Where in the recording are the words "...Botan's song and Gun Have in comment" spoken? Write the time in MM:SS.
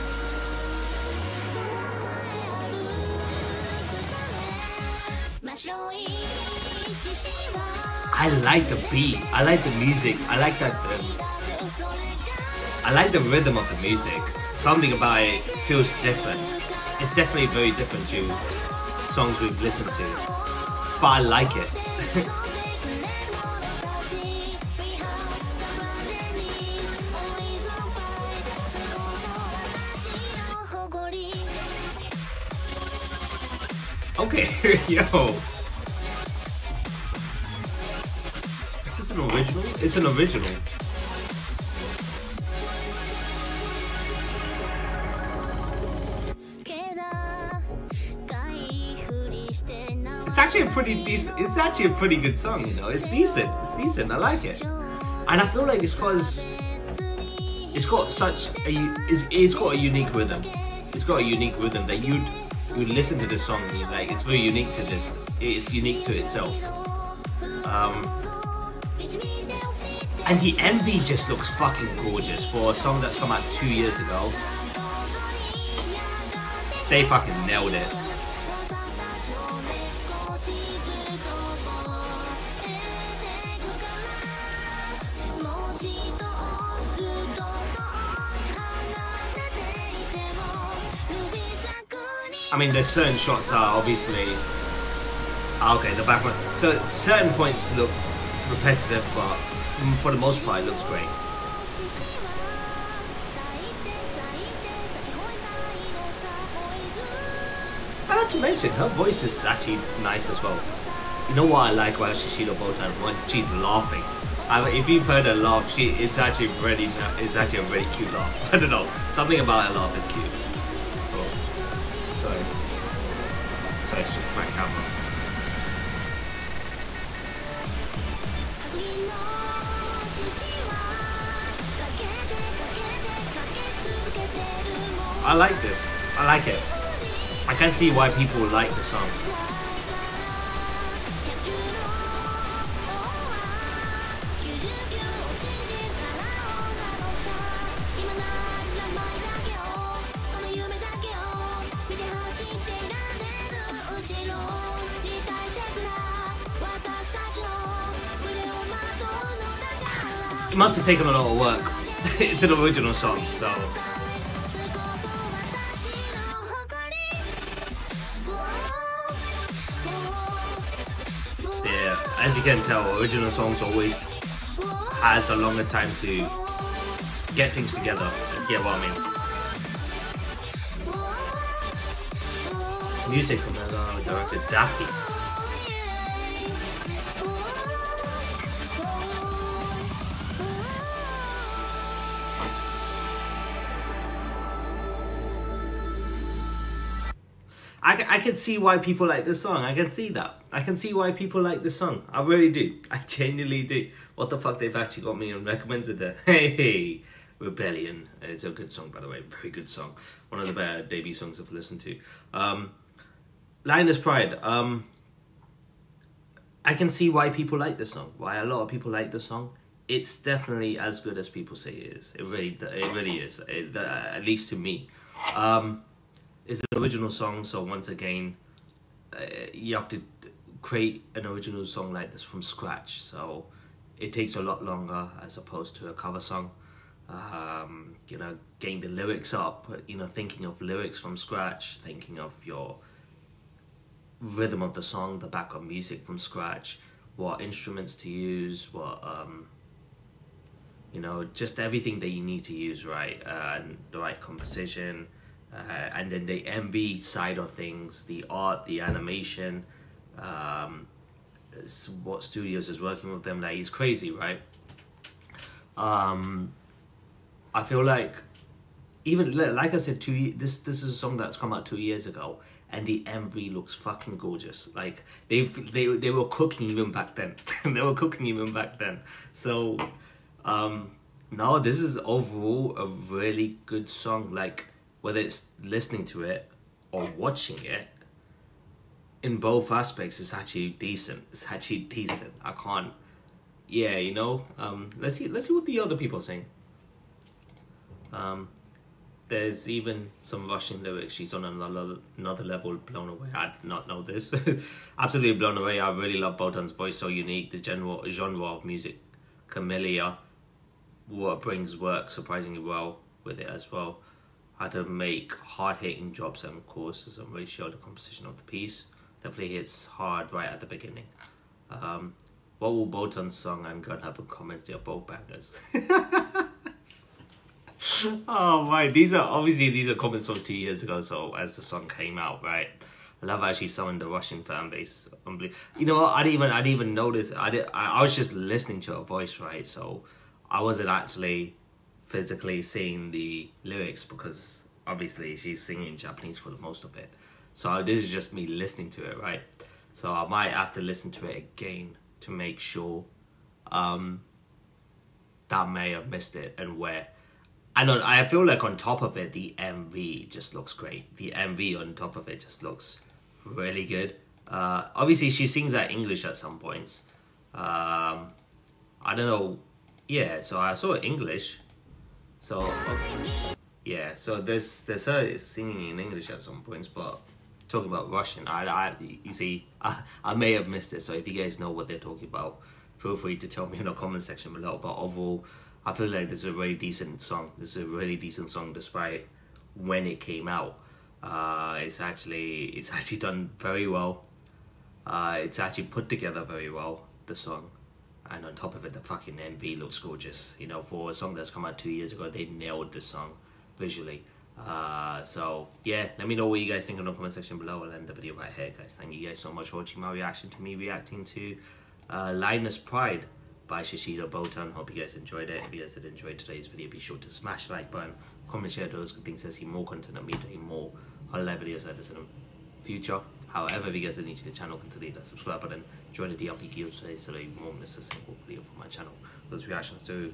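05:22.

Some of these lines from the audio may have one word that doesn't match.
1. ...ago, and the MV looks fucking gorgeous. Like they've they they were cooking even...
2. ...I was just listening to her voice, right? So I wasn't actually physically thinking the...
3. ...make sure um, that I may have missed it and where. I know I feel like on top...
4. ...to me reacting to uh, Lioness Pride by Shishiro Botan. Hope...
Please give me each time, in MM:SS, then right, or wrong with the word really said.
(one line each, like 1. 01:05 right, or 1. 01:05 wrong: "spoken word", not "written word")
1. 04:32 right
2. 05:37 wrong: "seeing", not "thinking"
3. 05:52 right
4. 06:50 right.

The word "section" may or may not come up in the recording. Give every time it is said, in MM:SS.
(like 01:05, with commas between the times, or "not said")
06:24, 06:47.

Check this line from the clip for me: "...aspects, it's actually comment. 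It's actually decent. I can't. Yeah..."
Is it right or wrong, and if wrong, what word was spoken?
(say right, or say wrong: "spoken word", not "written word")
wrong: "decent", not "comment".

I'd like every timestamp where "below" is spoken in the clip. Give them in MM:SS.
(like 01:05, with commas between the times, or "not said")
06:24, 06:47.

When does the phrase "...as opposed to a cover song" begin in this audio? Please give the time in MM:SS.
03:55.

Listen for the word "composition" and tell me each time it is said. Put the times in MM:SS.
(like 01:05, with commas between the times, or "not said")
04:14, 05:17.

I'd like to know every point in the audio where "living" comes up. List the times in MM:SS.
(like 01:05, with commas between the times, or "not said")
not said.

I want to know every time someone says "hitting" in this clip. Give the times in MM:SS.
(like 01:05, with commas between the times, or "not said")
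05:15.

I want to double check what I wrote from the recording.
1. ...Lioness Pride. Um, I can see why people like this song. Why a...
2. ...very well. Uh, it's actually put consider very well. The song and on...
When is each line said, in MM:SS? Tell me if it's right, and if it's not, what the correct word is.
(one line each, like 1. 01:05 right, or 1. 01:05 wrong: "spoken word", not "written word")
1. 03:33 right
2. 06:33 wrong: "together", not "consider".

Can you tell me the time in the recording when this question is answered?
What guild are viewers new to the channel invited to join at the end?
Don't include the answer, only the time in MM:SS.
07:06.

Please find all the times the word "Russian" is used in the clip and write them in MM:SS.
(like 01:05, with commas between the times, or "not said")
05:00, 05:34, 06:18.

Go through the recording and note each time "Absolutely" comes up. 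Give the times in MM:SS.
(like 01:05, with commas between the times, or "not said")
05:04.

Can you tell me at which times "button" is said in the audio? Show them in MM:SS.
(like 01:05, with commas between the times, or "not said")
06:57, 07:05.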